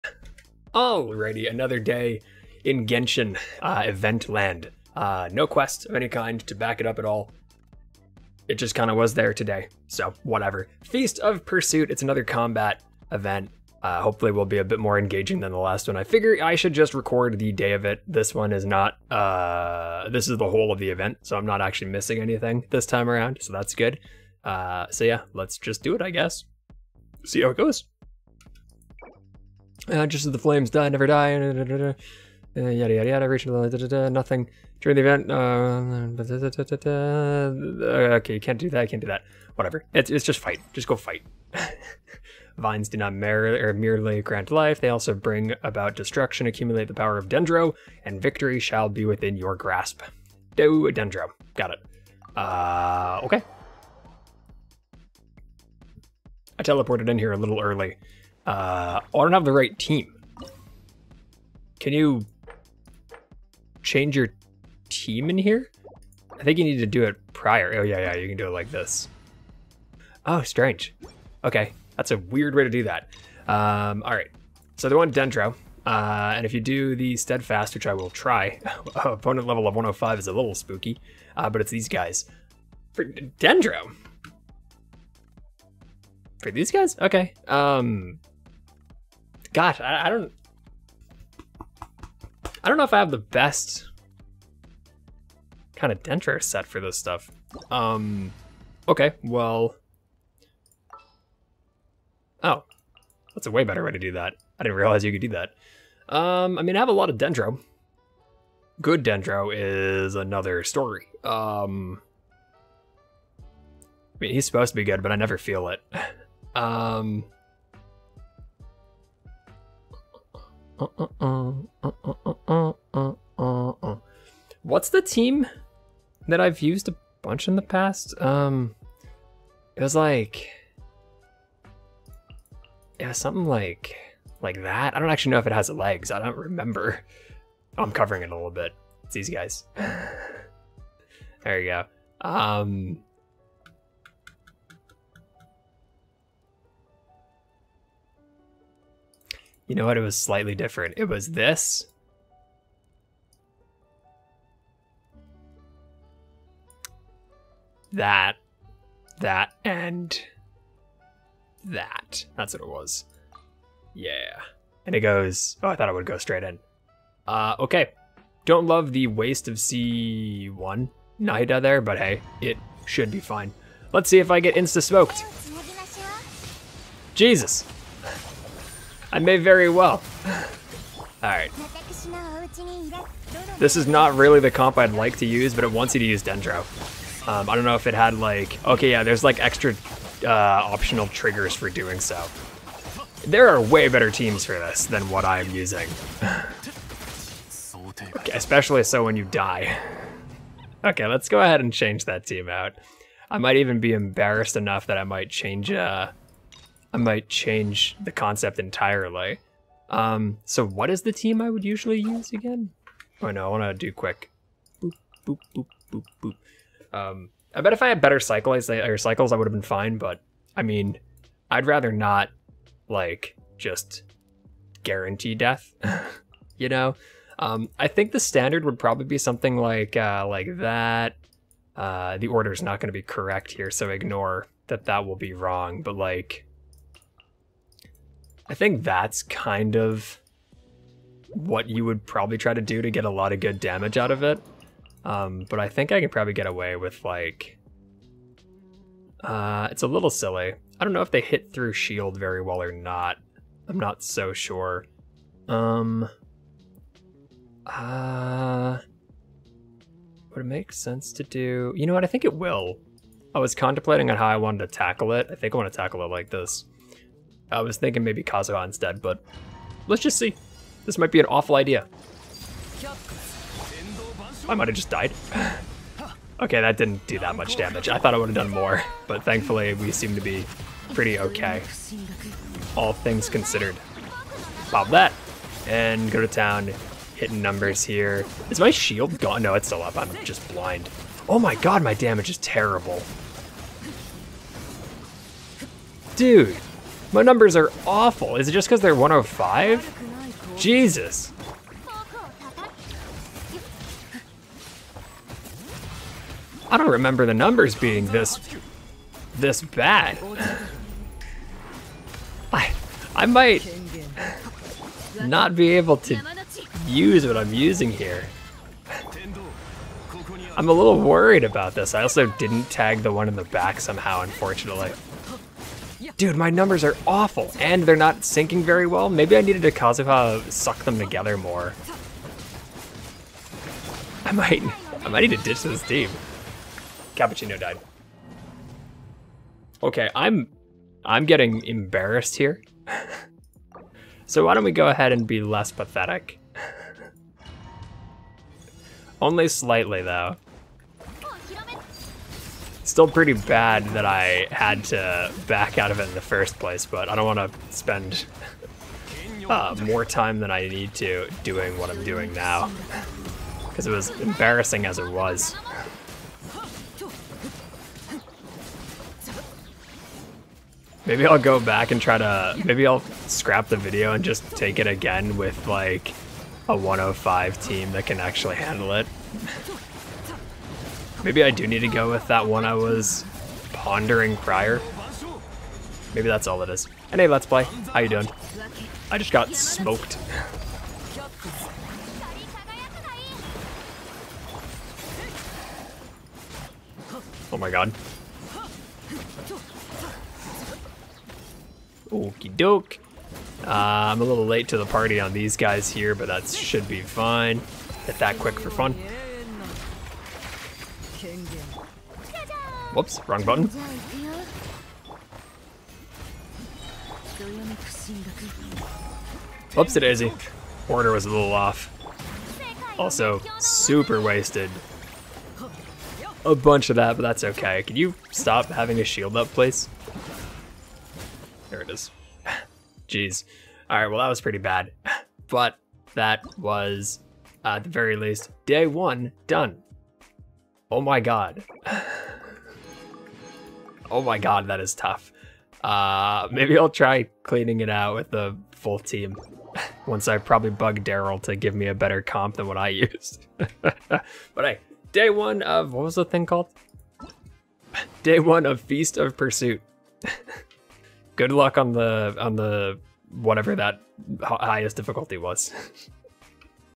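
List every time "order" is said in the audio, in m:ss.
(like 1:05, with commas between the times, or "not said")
3:52, 7:00.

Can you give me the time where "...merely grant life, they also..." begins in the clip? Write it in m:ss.
0:43.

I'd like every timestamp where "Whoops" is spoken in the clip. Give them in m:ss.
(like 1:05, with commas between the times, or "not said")
6:52, 6:59.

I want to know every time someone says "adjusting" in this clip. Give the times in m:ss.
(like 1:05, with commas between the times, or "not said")
not said.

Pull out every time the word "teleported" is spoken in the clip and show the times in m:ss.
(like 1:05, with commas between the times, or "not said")
0:56.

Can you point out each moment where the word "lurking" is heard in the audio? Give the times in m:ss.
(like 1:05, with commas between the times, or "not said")
not said.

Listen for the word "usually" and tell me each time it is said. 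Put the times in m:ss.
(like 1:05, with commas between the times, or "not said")
3:31.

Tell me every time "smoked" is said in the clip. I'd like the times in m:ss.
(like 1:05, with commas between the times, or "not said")
2:54, 6:29.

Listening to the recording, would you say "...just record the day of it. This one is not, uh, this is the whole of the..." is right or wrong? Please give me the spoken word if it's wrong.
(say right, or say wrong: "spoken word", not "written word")
right.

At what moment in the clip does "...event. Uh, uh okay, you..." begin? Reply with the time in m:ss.
0:35.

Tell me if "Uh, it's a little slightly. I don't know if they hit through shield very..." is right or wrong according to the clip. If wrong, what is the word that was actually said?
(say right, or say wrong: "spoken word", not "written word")
wrong: "silly", not "slightly".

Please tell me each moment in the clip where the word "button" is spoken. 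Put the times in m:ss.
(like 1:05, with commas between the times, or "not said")
6:53.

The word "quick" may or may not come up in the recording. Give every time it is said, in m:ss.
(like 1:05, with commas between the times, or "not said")
3:33, 6:48.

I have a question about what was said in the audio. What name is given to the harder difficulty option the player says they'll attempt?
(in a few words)
Steadfast.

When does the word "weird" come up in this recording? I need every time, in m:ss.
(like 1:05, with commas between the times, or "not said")
1:12.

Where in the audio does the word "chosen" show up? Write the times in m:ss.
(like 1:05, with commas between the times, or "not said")
not said.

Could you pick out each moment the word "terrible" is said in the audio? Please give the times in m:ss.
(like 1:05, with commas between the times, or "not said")
4:52.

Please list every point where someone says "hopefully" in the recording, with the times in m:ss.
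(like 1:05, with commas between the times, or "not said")
0:14.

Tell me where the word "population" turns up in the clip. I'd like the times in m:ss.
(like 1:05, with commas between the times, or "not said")
not said.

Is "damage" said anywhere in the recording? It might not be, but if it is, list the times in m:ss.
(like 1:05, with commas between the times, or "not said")
4:03, 4:37, 4:51.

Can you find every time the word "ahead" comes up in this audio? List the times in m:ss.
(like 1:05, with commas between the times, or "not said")
3:21, 5:44.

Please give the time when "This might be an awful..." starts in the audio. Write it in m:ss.
4:30.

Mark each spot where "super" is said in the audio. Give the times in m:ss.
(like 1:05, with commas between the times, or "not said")
7:03.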